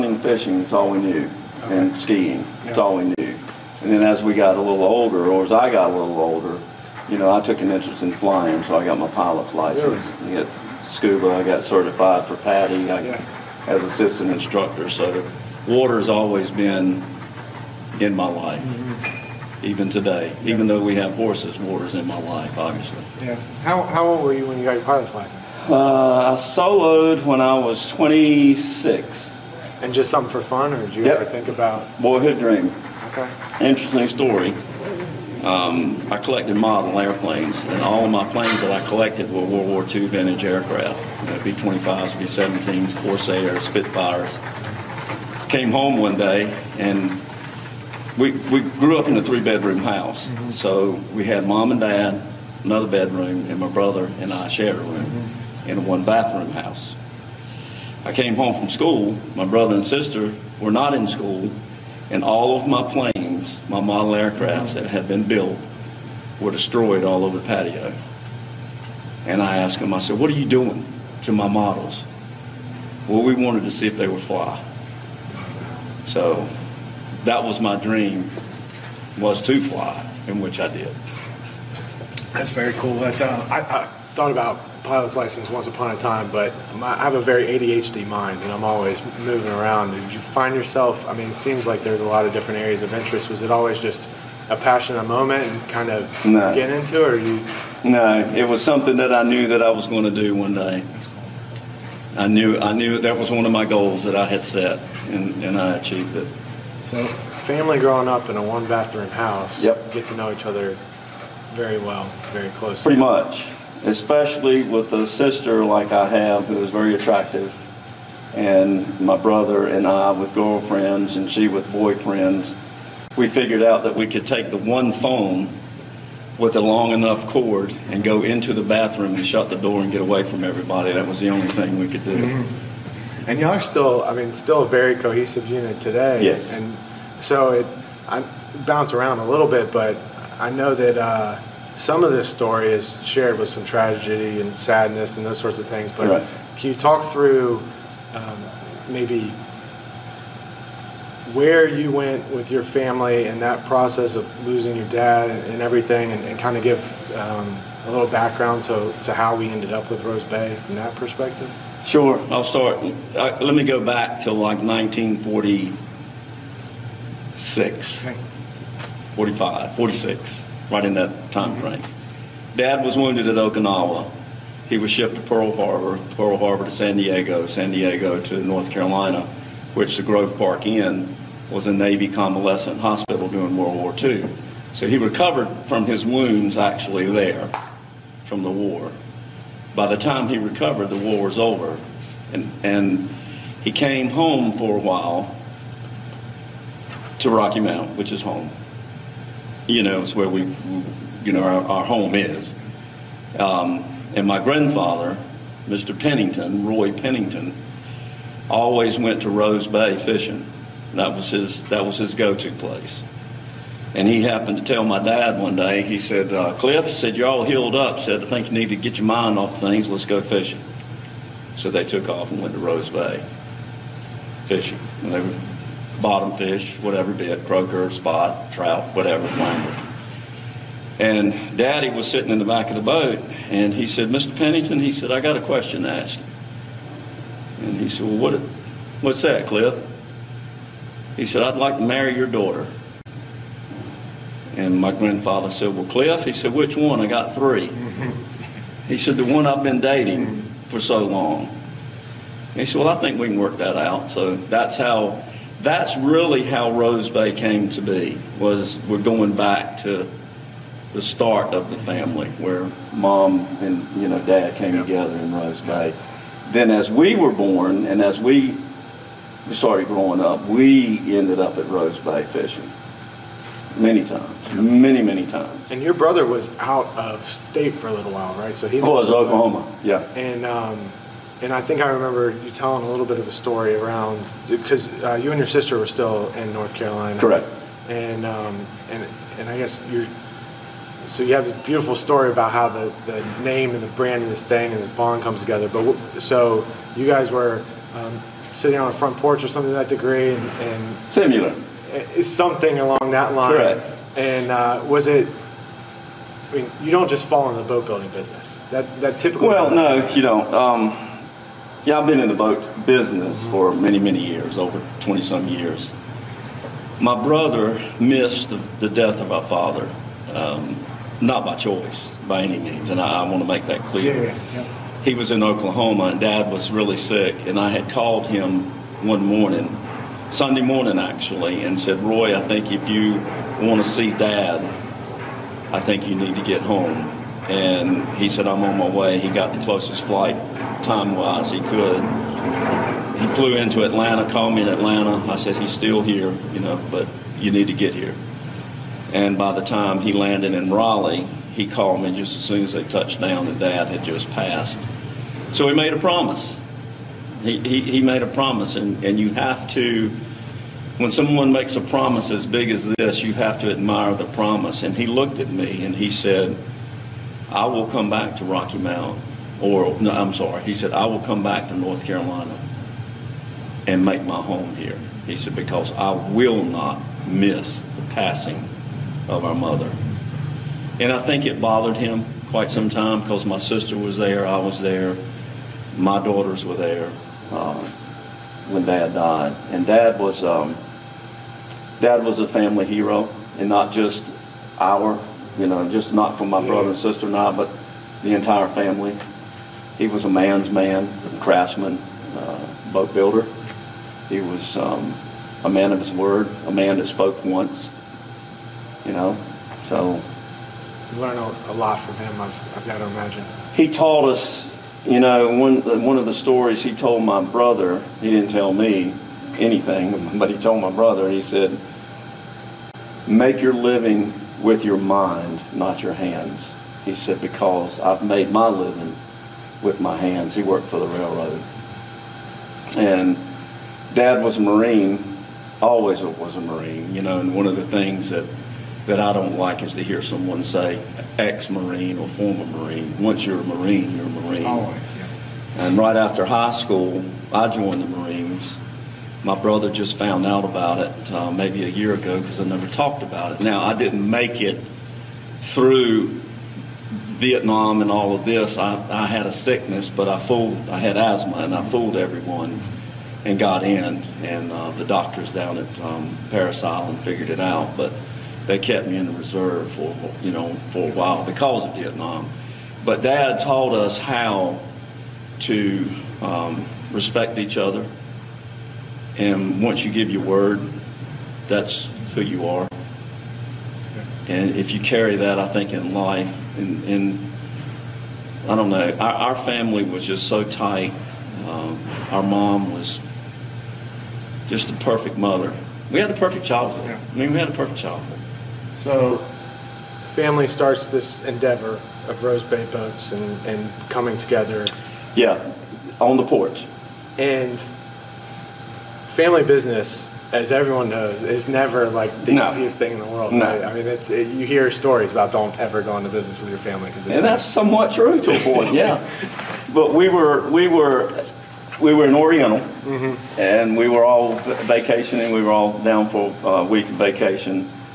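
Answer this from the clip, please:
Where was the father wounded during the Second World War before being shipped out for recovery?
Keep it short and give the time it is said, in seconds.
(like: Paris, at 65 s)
Okinawa, at 173 s.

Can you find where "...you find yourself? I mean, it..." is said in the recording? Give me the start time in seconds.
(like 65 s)
90 s.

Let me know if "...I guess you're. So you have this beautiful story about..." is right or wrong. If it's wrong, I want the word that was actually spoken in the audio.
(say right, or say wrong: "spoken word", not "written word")
right.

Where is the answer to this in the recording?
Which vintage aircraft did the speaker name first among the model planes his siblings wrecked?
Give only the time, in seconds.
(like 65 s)
41 s.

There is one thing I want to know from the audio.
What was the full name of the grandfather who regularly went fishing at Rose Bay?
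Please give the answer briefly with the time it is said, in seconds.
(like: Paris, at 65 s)
Roy Pennington, at 206 s.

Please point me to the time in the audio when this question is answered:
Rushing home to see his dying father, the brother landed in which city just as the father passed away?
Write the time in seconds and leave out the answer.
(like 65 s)
350 s.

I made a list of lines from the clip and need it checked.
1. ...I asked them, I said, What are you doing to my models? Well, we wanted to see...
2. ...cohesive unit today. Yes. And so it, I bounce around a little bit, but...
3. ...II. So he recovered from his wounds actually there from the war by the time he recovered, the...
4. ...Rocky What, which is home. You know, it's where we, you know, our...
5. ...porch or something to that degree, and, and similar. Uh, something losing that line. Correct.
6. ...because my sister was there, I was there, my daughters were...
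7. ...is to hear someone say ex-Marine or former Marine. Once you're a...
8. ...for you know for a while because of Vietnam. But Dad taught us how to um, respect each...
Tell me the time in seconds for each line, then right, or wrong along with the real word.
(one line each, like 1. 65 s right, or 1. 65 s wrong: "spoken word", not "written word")
1. 69 s right
2. 134 s right
3. 183 s right
4. 197 s wrong: "Mount", not "What"
5. 299 s wrong: "along", not "losing"
6. 383 s right
7. 439 s right
8. 469 s right.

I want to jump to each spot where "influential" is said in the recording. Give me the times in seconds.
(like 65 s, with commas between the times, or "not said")
not said.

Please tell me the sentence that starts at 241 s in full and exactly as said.
He said, I'd like to marry your daughter.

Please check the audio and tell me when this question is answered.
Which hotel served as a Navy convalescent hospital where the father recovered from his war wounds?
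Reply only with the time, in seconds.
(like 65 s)
180 s.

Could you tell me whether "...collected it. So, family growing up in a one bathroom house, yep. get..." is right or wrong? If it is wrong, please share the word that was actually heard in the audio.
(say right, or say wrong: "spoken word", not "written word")
wrong: "achieved", not "collected".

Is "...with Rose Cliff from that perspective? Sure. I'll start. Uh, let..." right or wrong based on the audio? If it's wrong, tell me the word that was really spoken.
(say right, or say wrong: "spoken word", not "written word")
wrong: "Bay", not "Cliff".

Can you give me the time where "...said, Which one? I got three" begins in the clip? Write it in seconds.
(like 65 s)
246 s.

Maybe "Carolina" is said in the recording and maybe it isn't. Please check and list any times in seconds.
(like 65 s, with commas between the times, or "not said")
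178 s, 286 s, 372 s.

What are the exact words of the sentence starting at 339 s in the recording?
He got the closest flight time wise he could.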